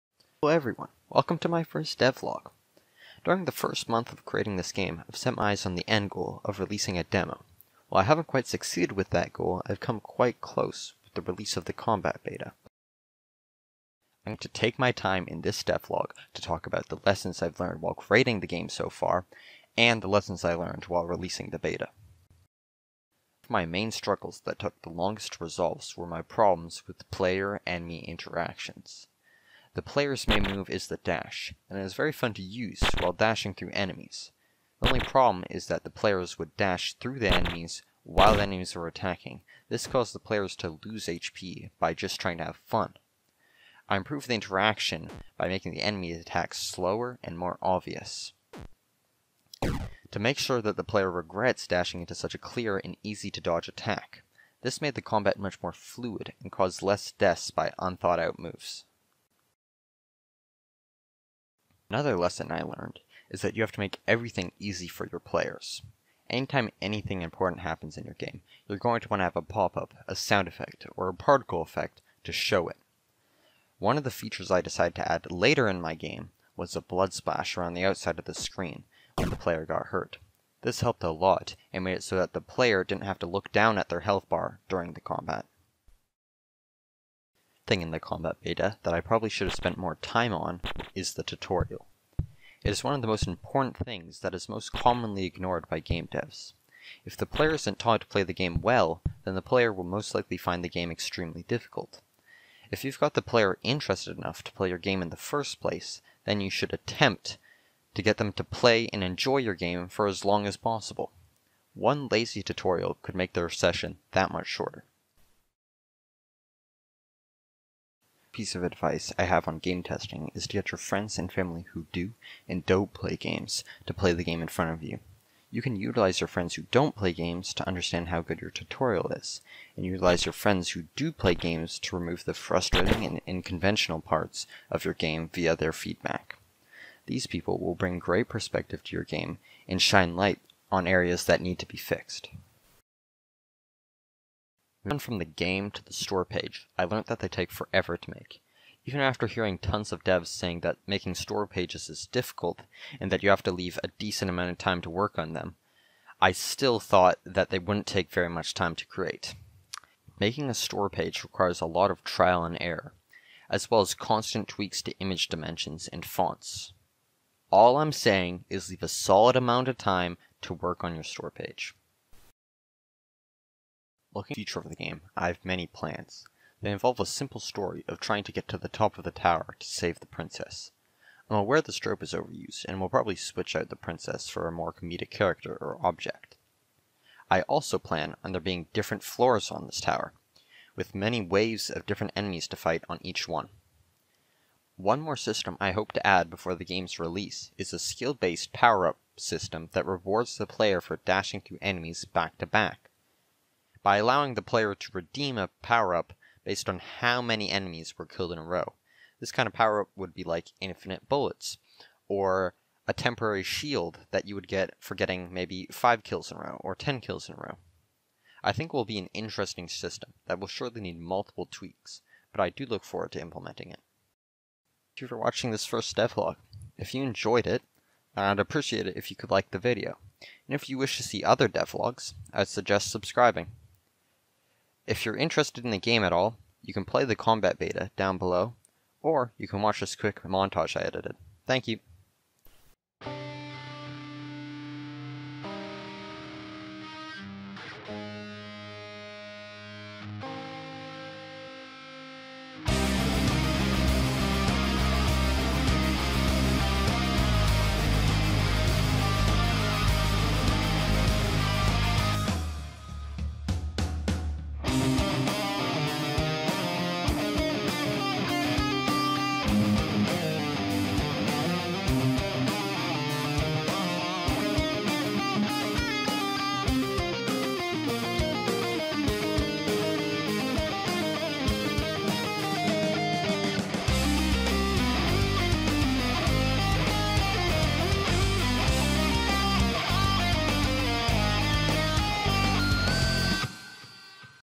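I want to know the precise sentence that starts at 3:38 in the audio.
I think will be an interesting system that will surely need multiple tweaks, but I do look forward to implementing it.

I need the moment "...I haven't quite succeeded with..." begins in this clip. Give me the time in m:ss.
0:08.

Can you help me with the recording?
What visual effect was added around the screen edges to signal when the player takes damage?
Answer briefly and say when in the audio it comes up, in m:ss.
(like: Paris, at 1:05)
Blood splash, at 1:16.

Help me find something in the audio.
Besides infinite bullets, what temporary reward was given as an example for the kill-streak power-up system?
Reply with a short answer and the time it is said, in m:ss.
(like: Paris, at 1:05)
Shield, at 3:33.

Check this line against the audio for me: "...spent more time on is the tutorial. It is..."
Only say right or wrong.
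right.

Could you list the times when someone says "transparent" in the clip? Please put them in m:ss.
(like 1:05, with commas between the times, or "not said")
not said.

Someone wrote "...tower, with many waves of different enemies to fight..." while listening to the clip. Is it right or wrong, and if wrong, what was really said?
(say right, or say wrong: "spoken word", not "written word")
right.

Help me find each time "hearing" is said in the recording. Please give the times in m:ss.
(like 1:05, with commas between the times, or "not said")
2:29.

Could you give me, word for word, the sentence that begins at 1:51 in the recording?
One lazy tutorial could make their session that much shorter.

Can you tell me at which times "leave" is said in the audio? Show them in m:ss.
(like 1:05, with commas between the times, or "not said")
2:33, 2:48.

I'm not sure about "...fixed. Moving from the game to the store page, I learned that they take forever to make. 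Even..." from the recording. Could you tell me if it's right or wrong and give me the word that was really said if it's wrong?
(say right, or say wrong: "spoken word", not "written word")
right.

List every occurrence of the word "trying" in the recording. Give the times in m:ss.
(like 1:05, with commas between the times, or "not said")
0:42, 2:58.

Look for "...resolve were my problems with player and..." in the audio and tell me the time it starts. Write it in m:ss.
0:25.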